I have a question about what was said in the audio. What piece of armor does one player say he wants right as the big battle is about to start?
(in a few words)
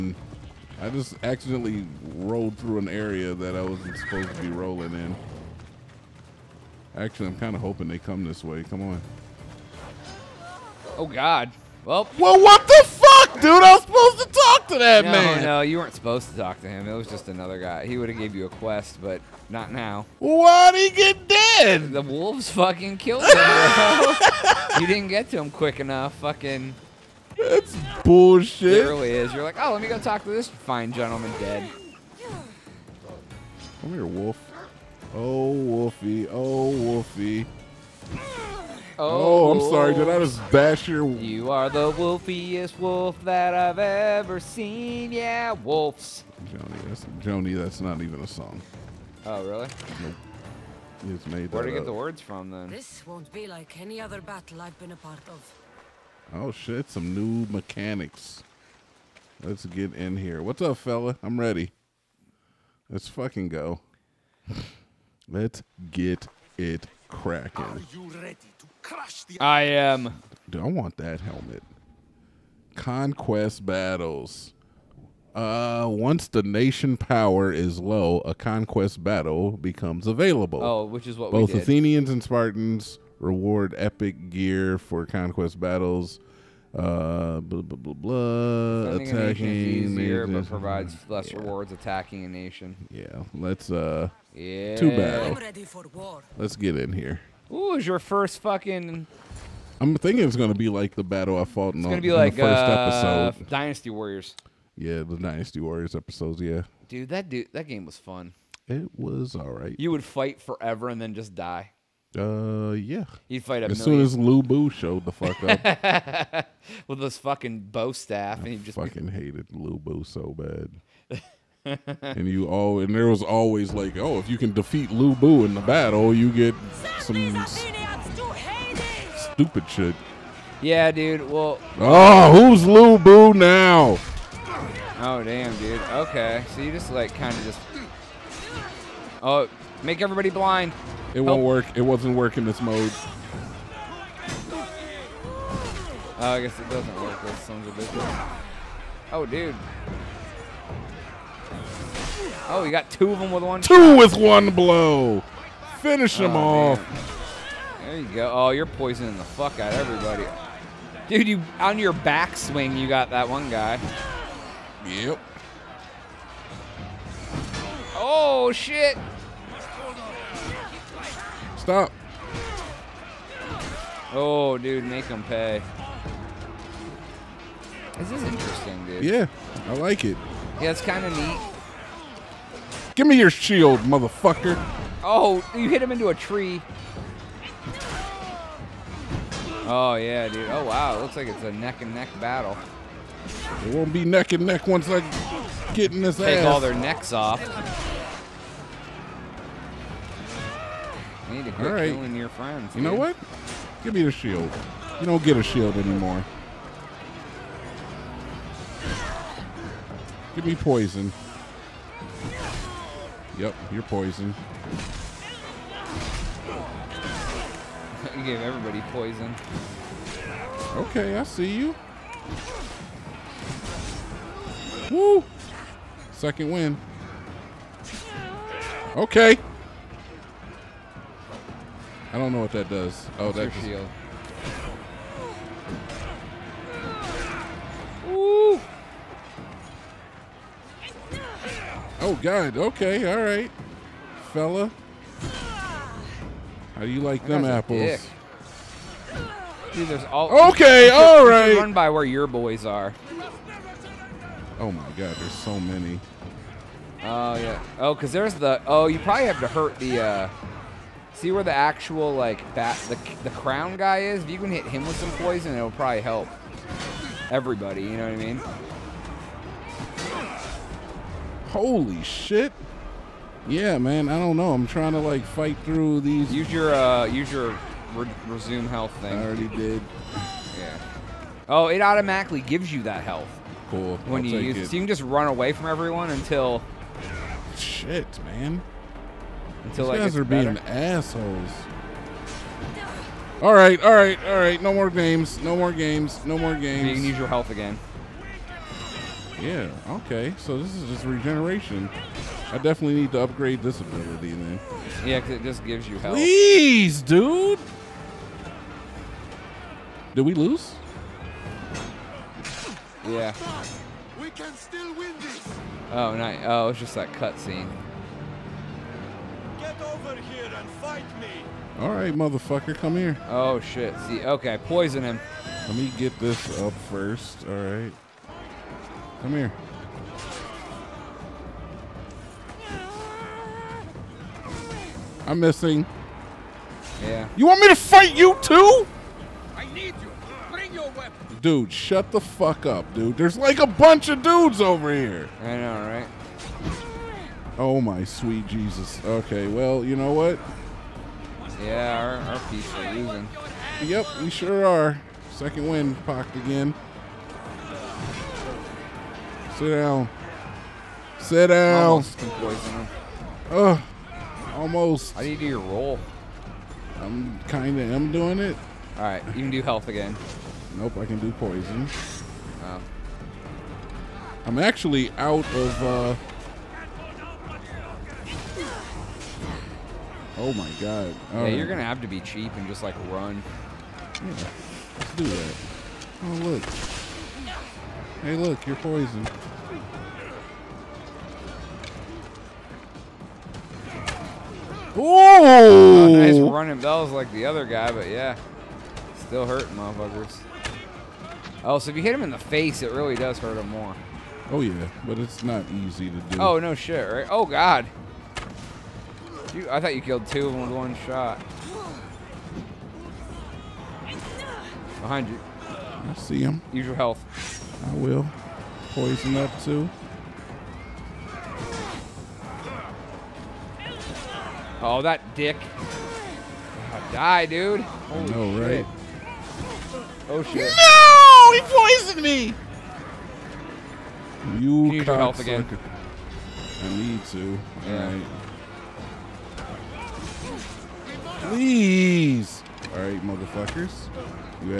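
That helmet.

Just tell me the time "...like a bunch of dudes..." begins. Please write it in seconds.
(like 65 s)
343 s.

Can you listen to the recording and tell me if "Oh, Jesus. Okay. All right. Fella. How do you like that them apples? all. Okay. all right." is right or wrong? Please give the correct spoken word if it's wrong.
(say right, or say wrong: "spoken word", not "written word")
wrong: "God", not "Jesus".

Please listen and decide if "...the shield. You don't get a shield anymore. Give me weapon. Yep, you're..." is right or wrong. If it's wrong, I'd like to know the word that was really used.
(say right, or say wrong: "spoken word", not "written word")
wrong: "poison", not "weapon".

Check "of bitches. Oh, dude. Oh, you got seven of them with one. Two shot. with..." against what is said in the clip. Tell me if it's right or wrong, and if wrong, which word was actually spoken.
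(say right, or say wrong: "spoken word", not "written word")
wrong: "two", not "seven".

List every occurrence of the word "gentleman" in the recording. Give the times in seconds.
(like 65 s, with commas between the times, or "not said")
30 s.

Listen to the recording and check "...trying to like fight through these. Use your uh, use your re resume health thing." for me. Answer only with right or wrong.
right.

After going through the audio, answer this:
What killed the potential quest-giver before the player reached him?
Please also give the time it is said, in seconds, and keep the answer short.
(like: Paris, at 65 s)
The wolves, at 21 s.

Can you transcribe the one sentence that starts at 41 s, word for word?
You are the wolfiest wolf that I've ever seen.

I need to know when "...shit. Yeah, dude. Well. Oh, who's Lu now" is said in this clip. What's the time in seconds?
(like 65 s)
129 s.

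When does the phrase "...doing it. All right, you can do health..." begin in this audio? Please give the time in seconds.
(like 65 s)
368 s.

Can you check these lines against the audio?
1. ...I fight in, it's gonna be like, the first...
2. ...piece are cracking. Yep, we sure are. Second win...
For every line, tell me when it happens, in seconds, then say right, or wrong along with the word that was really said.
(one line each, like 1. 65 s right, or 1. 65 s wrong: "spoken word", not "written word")
1. 101 s wrong: "fought", not "fight"
2. 352 s wrong: "losing", not "cracking".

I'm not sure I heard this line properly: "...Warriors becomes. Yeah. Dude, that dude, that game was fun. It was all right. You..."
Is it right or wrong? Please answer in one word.
wrong.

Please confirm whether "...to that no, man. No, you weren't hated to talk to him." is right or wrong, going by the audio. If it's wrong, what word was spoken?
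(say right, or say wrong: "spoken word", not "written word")
wrong: "supposed", not "hated".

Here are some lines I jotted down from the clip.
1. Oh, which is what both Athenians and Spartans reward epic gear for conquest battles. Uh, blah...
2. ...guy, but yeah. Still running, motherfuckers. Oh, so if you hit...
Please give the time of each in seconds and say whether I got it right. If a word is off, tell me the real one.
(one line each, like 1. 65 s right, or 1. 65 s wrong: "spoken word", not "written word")
1. 80 s right
2. 397 s wrong: "hurting", not "running".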